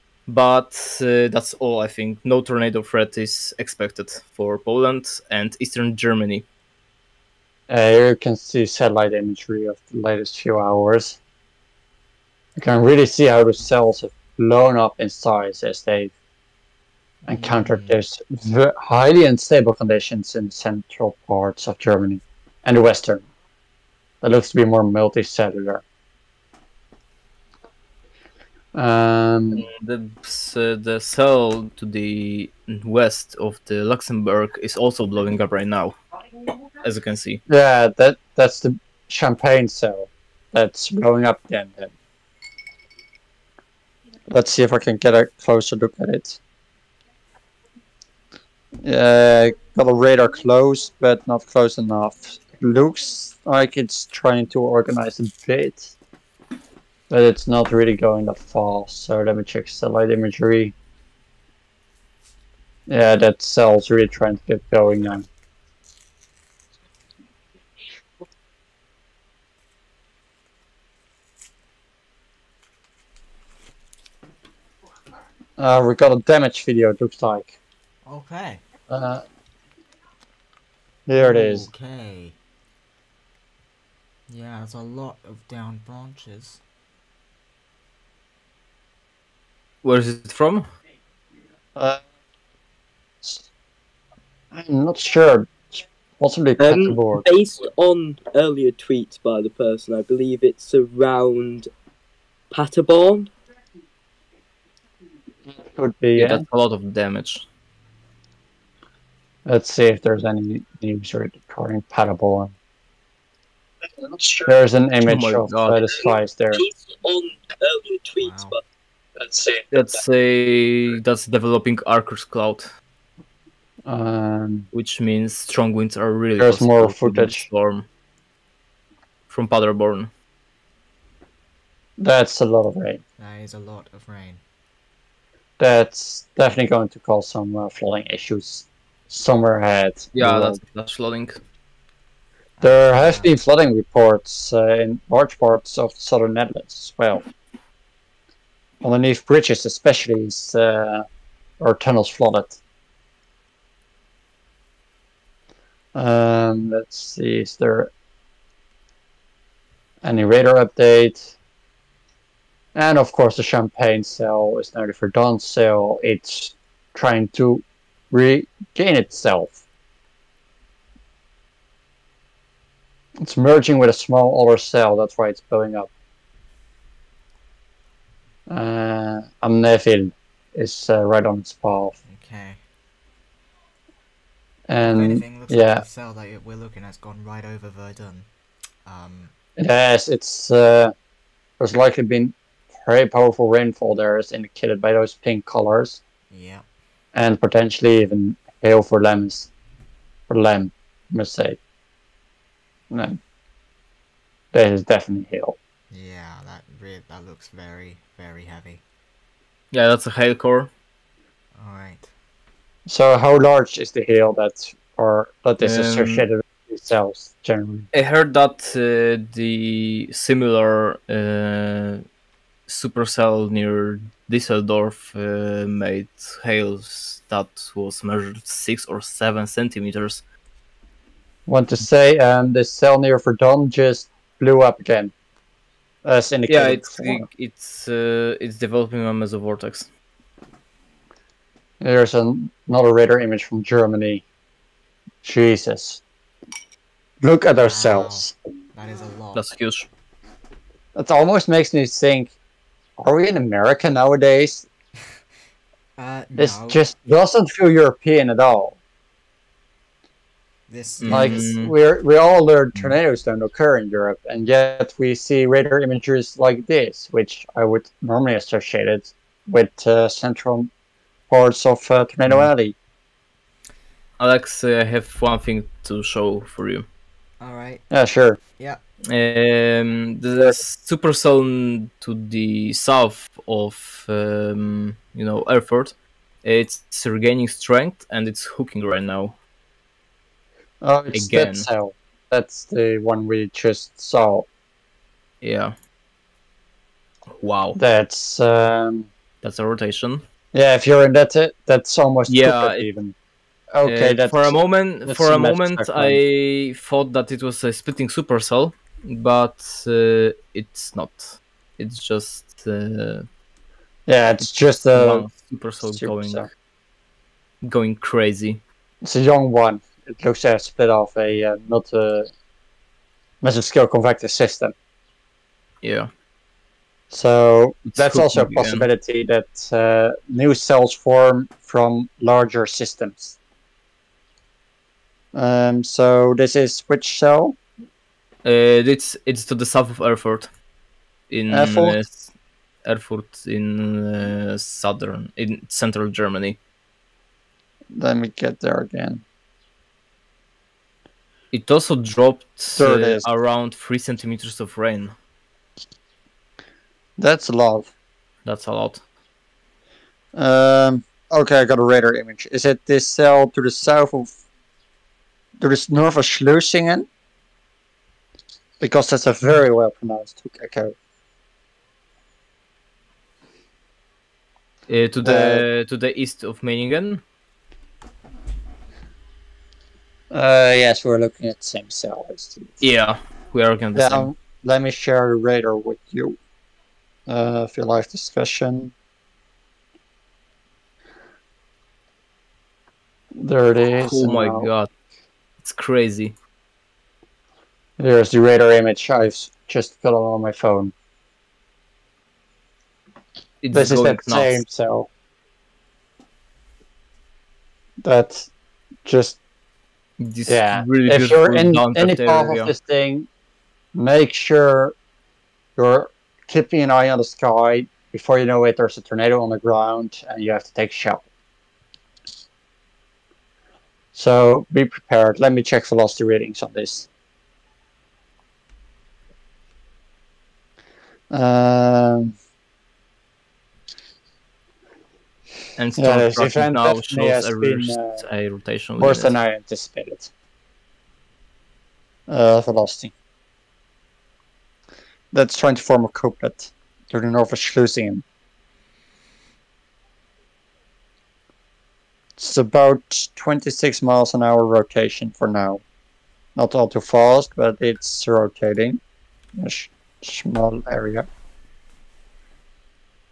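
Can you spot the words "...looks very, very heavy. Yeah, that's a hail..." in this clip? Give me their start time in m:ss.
3:27.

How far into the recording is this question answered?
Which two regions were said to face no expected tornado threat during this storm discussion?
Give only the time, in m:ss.
0:04.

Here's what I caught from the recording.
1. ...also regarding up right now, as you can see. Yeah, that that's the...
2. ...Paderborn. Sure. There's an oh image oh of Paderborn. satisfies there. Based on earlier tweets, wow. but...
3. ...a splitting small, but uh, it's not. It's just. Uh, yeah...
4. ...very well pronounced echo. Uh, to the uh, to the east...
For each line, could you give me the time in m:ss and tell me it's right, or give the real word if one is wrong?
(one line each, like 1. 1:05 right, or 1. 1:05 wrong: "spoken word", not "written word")
1. 0:34 wrong: "blowing", not "regarding"
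2. 1:51 wrong: "God", not "Paderborn"
3. 5:07 wrong: "supercell", not "small"
4. 6:09 right.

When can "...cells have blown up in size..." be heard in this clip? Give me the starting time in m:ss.
0:13.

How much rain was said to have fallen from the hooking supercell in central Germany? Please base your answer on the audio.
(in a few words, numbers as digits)
3 centimeters.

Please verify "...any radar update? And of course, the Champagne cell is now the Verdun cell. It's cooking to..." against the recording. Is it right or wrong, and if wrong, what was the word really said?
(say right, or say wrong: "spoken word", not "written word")
wrong: "trying", not "cooking".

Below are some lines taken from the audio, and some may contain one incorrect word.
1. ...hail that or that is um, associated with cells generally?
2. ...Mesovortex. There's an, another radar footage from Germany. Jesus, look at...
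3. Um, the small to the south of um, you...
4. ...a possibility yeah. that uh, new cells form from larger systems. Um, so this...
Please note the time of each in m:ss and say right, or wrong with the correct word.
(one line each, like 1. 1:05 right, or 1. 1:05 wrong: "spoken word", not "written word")
1. 3:34 right
2. 3:59 wrong: "image", not "footage"
3. 4:39 wrong: "supercell", not "small"
4. 5:28 right.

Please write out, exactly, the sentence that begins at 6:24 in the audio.
Let me share the radar with you.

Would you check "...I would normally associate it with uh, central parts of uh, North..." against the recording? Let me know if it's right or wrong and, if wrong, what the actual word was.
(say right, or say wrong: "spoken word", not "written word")
wrong: "Tornado", not "North".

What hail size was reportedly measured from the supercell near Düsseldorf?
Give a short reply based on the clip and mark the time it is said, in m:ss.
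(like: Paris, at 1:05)
6 or 7 centimeters, at 3:48.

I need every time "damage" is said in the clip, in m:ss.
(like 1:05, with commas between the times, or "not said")
1:16, 1:46.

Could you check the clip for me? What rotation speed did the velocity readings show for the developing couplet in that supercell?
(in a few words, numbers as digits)
26 miles an hour.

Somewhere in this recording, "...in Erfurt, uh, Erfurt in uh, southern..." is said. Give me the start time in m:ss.
5:41.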